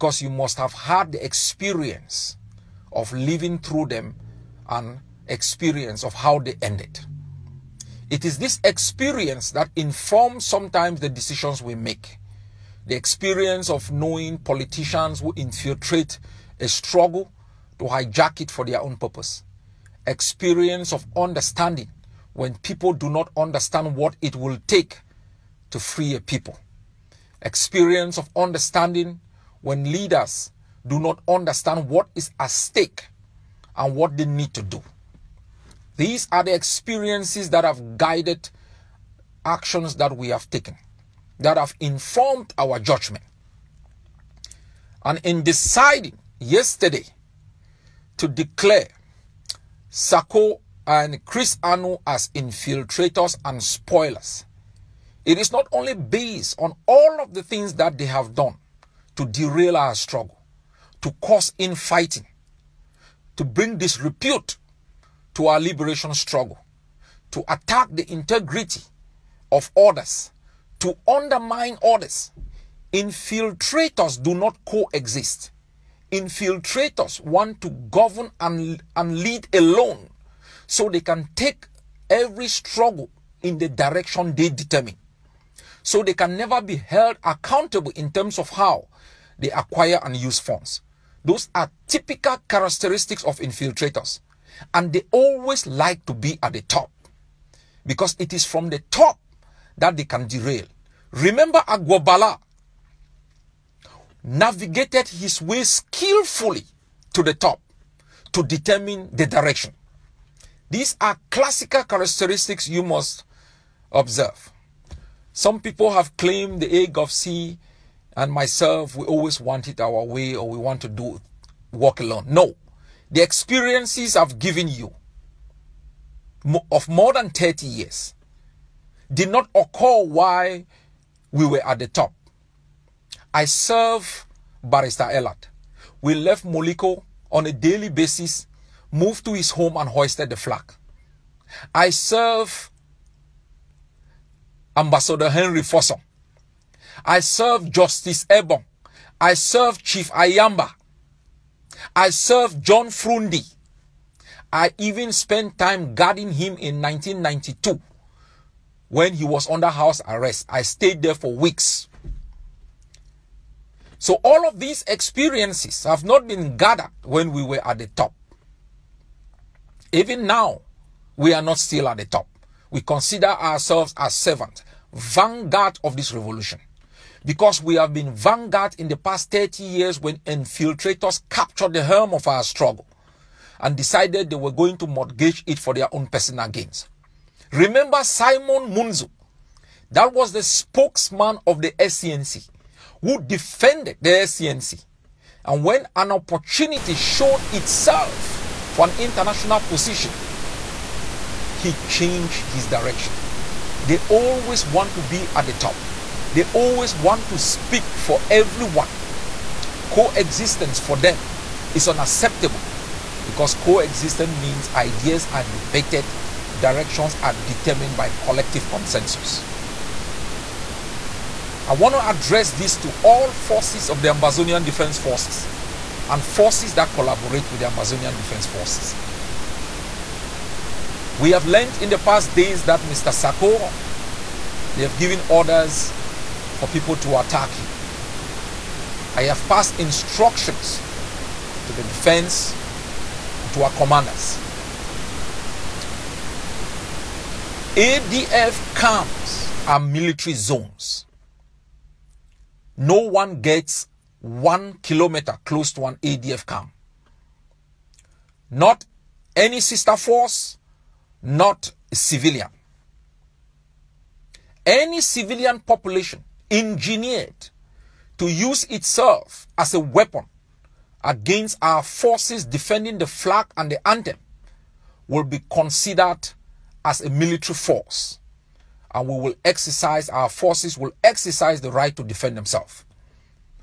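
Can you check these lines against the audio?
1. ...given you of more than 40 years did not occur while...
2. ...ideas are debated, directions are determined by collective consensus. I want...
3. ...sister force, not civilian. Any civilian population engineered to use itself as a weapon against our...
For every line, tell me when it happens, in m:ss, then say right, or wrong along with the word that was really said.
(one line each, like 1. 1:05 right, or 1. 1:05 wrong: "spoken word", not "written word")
1. 2:04 wrong: "30", not "40"
2. 3:34 right
3. 4:19 right.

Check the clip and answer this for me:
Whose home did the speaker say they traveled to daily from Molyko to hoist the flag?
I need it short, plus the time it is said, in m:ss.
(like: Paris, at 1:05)
Barrister Elat, at 2:14.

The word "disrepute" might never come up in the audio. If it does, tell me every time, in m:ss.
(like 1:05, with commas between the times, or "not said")
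1:03.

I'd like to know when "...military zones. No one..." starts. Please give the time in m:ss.
4:09.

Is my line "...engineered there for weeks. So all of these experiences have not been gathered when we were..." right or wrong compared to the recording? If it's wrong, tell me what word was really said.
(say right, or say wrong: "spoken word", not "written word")
wrong: "stayed", not "engineered".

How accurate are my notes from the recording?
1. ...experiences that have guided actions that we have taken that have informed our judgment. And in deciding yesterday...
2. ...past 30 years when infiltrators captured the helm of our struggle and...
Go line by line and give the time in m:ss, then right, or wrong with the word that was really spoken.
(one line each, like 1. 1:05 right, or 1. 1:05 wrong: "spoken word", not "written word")
1. 0:36 right
2. 2:58 right.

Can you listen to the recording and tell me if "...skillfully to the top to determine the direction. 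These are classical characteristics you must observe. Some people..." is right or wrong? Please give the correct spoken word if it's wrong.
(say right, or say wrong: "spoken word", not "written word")
right.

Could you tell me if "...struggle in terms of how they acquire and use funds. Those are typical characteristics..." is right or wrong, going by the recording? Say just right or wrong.
wrong.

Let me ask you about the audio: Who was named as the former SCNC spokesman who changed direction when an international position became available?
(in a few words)
Simon Munzu.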